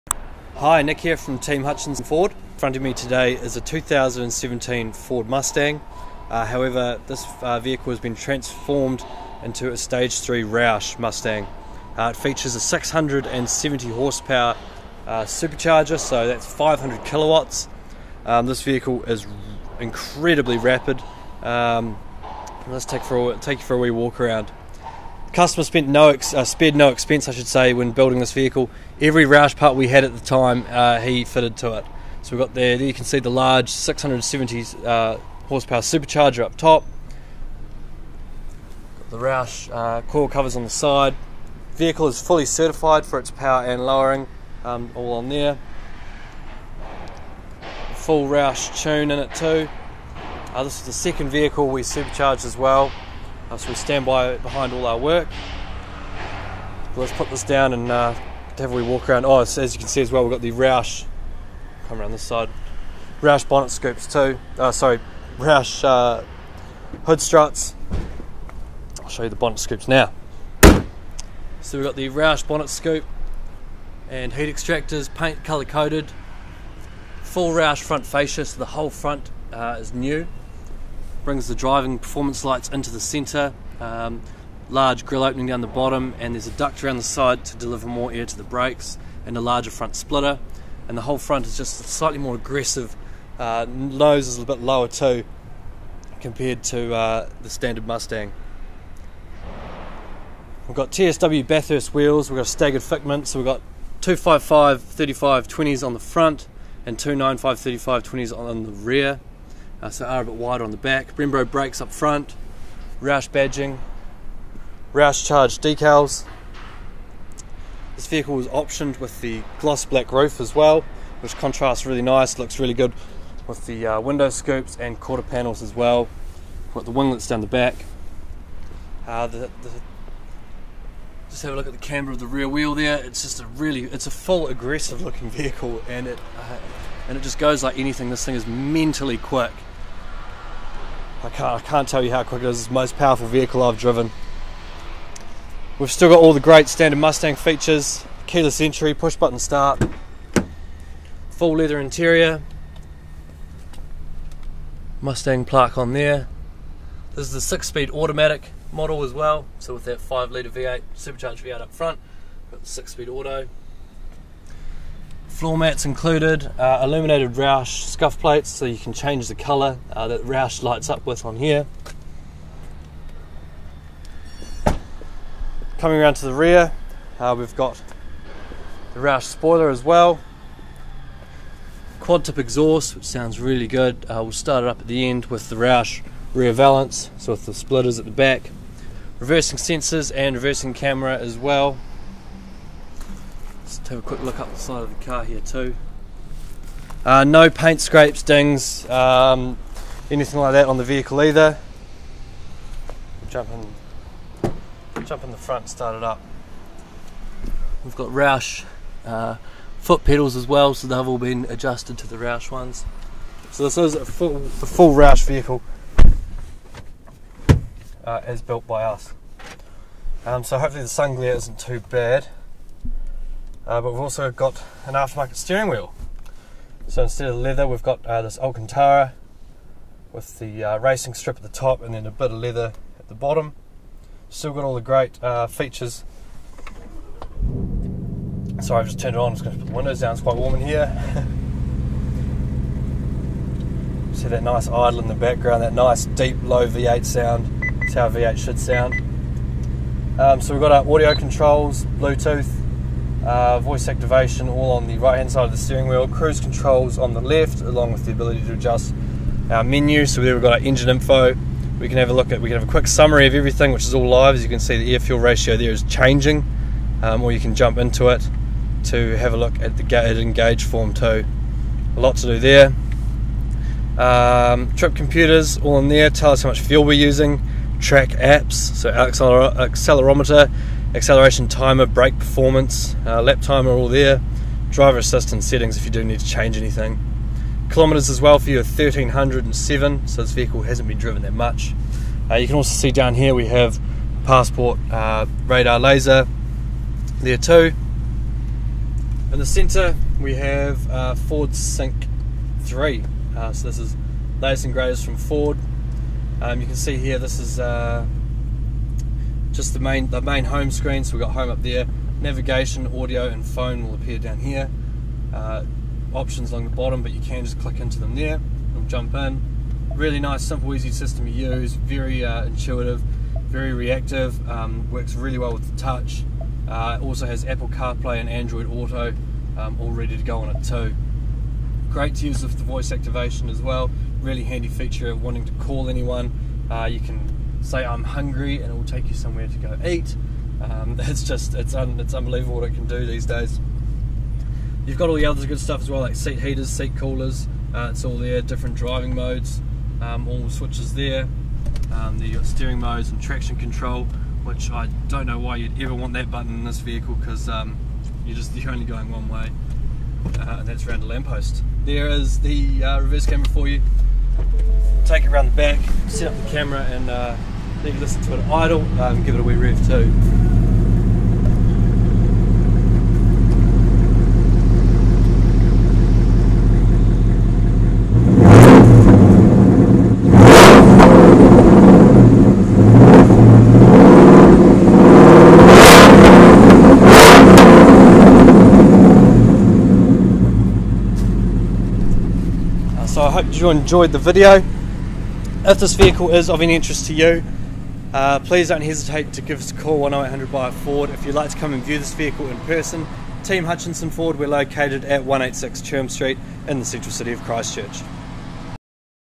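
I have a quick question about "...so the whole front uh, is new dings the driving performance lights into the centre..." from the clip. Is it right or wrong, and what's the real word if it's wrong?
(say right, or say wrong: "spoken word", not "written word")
wrong: "brings", not "dings".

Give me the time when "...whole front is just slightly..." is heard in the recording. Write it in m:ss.
1:31.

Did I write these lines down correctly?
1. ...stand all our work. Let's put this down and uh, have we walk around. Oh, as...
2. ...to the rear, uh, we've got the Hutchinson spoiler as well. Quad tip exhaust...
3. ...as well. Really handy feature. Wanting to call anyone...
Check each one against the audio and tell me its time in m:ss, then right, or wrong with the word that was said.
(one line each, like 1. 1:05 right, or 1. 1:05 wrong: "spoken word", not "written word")
1. 0:54 wrong: "behind", not "stand"
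2. 2:56 wrong: "Roush", not "Hutchinson"
3. 5:33 right.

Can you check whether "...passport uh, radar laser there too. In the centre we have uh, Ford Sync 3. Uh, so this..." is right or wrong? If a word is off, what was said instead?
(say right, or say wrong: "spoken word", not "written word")
right.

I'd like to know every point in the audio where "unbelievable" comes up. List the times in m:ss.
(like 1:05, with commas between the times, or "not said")
5:42.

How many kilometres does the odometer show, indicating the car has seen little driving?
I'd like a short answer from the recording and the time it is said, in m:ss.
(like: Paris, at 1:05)
1307, at 4:48.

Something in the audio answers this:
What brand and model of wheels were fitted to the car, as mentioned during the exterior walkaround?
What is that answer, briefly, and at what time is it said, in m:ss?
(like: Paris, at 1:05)
TSW Bathurst, at 1:40.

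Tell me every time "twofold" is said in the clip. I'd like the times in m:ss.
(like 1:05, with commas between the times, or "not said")
not said.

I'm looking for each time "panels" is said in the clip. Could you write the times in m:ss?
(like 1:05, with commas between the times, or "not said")
2:05.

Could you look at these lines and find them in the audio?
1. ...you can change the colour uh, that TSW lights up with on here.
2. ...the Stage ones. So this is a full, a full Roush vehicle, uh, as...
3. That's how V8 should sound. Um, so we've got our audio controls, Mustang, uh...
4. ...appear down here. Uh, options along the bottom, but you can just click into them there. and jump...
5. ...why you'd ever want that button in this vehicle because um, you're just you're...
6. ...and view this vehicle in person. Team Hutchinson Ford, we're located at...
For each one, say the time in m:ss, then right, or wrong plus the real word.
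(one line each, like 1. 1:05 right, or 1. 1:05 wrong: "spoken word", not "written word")
1. 2:48 wrong: "Roush", not "TSW"
2. 3:32 wrong: "Roush", not "Stage"
3. 4:07 wrong: "Bluetooth", not "Mustang"
4. 5:13 right
5. 5:55 right
6. 6:41 right.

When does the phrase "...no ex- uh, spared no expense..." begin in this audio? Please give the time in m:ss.
0:25.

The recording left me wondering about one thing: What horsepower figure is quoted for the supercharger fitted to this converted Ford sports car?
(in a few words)
670.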